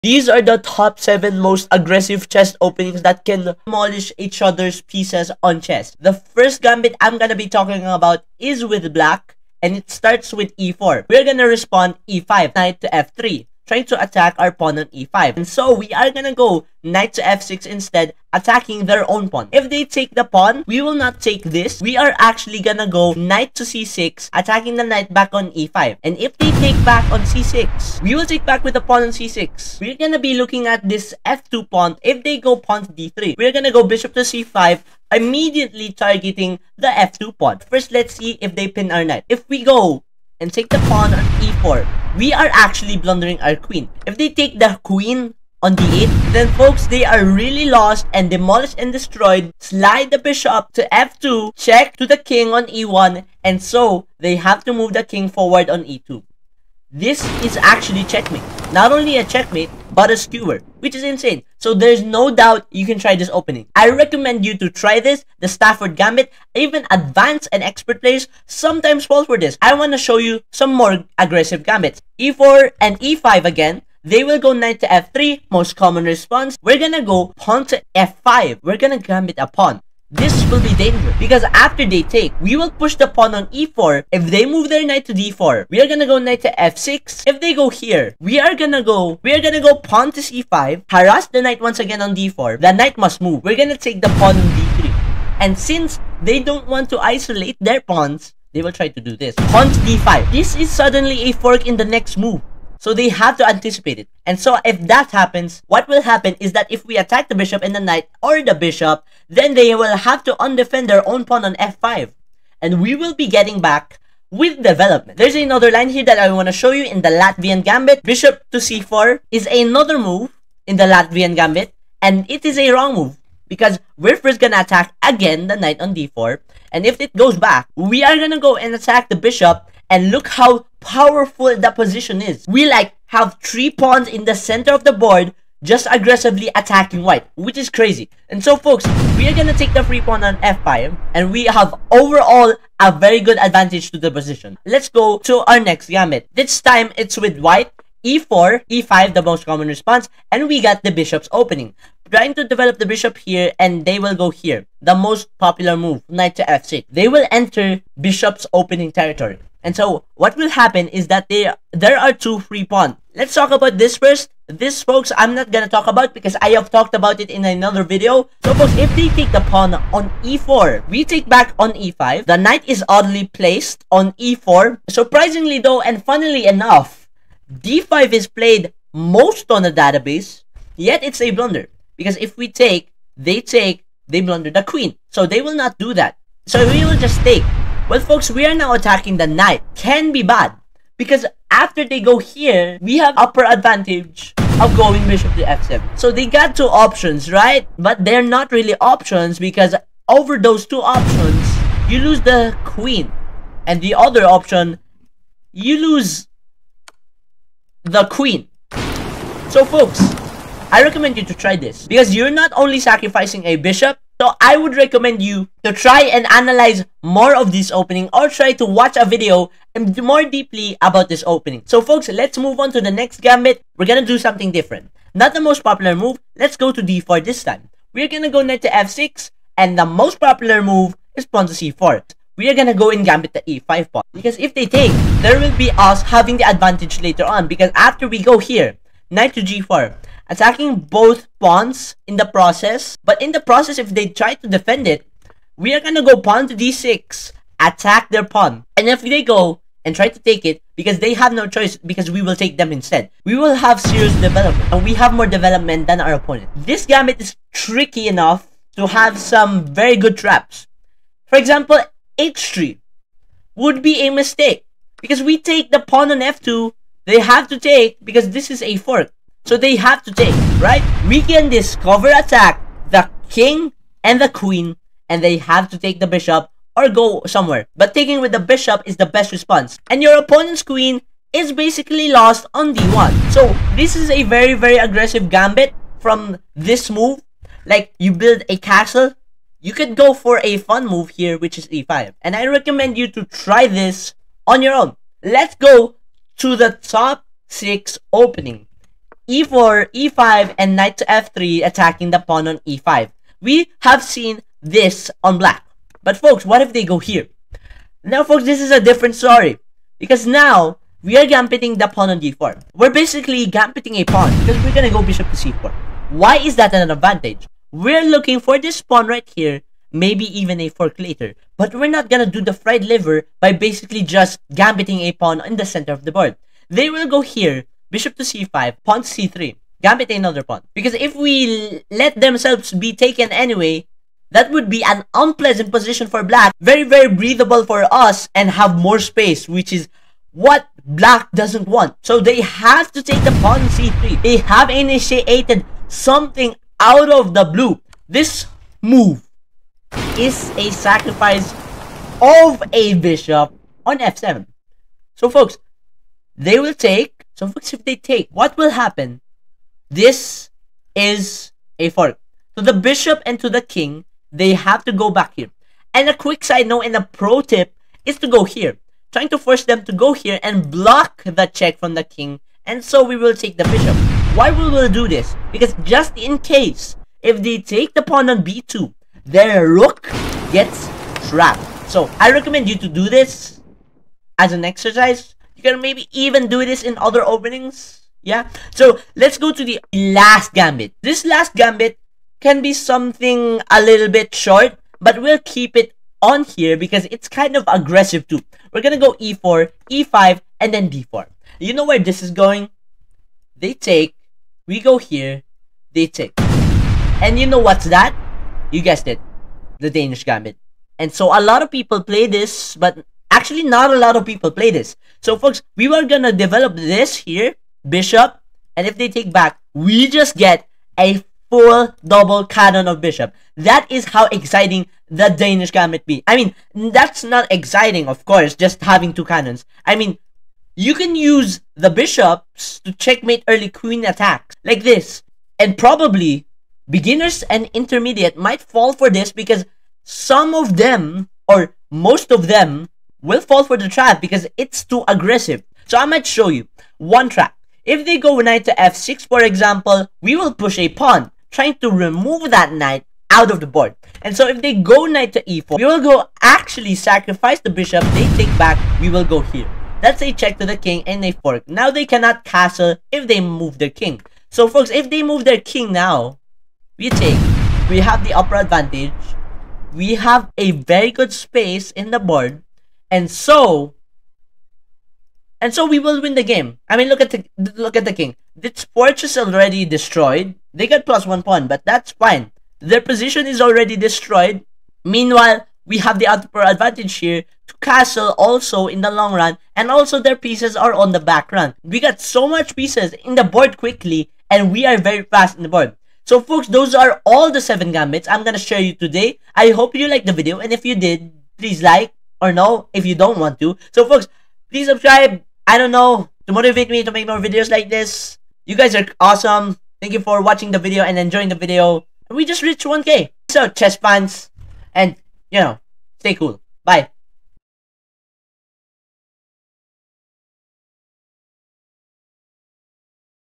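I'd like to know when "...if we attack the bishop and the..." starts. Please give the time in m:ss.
1:46.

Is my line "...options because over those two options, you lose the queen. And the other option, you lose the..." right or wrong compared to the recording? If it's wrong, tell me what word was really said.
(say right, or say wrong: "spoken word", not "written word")
right.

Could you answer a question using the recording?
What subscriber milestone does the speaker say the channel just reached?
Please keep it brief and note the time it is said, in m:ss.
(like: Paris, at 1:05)
1k, at 8:32.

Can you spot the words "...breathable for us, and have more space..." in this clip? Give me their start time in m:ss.
5:37.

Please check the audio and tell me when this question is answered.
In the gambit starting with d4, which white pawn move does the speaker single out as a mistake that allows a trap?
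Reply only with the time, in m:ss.
4:22.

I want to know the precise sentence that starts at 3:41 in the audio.
So folks, let's move on to the next gambit.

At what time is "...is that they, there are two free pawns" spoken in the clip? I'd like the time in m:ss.
2:40.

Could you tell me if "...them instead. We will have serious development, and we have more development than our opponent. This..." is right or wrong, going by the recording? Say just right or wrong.
right.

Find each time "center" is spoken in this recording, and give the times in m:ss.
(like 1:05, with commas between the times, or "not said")
2:14, 5:25.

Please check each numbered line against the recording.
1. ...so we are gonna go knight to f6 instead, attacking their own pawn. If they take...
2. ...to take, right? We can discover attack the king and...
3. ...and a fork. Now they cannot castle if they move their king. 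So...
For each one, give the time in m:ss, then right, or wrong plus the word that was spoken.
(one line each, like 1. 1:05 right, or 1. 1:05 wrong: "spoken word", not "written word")
1. 0:15 right
2. 4:30 right
3. 7:41 right.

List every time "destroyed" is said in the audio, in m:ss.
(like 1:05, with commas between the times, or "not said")
0:48, 7:59, 8:03.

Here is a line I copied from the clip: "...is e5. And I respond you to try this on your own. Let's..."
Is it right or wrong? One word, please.
wrong.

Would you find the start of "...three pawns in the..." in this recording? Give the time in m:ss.
2:13.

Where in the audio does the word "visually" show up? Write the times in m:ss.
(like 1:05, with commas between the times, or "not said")
not said.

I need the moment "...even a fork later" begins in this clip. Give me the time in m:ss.
5:20.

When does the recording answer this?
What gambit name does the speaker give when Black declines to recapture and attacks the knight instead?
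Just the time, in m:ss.
1:05.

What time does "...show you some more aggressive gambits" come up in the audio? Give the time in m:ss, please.
1:09.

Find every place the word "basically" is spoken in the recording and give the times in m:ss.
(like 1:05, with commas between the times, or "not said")
4:41, 5:13, 5:23.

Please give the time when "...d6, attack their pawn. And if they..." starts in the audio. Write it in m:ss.
4:06.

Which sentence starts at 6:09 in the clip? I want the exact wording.
Trying to force them to go here and block the check from the king.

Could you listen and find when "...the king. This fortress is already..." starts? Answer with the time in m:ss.
7:58.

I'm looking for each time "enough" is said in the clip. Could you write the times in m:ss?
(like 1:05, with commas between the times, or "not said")
2:56, 4:18.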